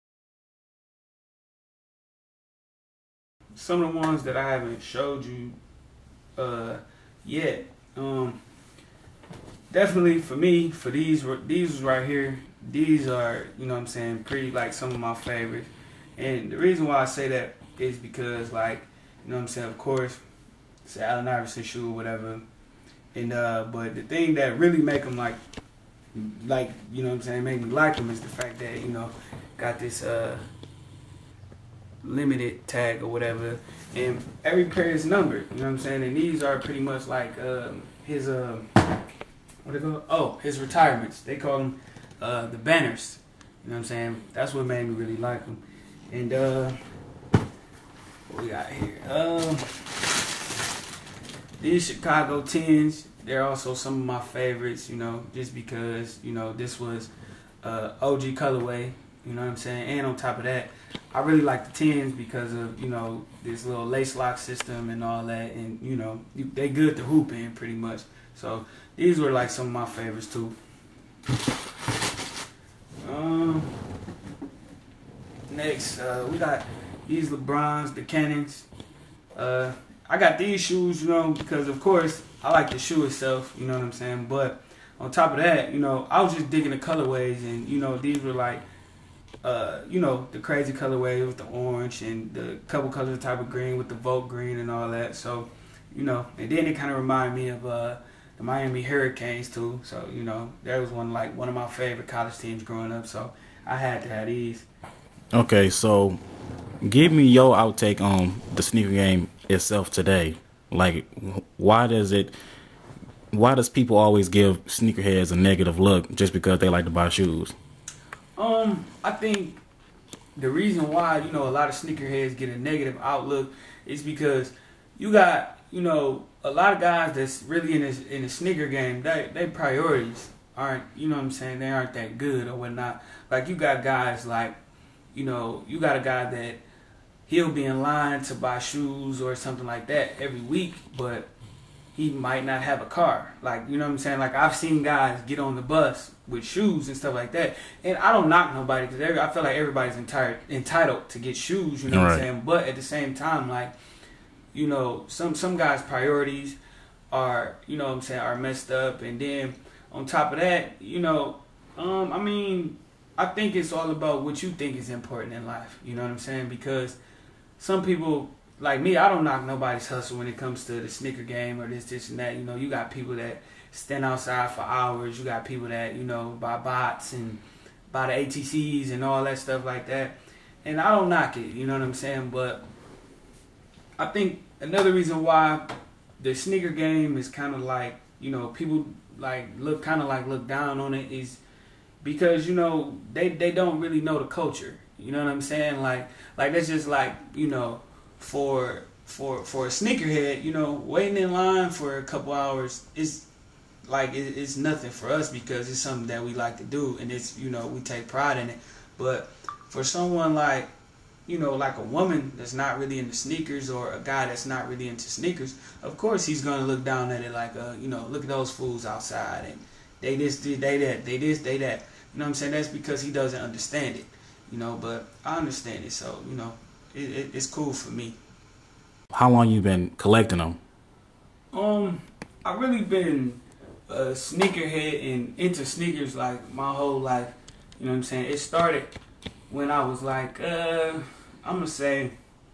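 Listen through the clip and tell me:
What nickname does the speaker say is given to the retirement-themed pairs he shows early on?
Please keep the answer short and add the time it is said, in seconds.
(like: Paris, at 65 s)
the banners, at 42 s.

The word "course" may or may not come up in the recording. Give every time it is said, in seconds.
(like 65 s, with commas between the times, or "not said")
19 s, 81 s, 215 s.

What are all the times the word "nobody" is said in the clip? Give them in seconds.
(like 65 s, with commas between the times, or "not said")
148 s, 169 s.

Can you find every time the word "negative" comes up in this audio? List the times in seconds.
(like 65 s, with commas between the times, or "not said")
115 s, 122 s.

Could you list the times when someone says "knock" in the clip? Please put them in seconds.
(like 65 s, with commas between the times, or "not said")
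148 s, 169 s, 181 s.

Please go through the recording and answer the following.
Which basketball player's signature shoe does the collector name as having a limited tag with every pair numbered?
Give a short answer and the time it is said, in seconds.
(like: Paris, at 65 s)
Allen Iverson, at 20 s.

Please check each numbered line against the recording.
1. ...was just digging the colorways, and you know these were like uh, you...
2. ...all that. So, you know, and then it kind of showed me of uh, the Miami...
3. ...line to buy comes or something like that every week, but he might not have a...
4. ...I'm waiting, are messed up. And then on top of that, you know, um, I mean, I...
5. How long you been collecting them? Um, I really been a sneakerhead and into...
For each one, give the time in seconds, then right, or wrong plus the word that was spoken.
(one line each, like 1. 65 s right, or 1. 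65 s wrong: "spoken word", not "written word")
1. 86 s right
2. 94 s wrong: "reminded", not "showed"
3. 137 s wrong: "shoes", not "comes"
4. 157 s wrong: "saying", not "waiting"
5. 229 s right.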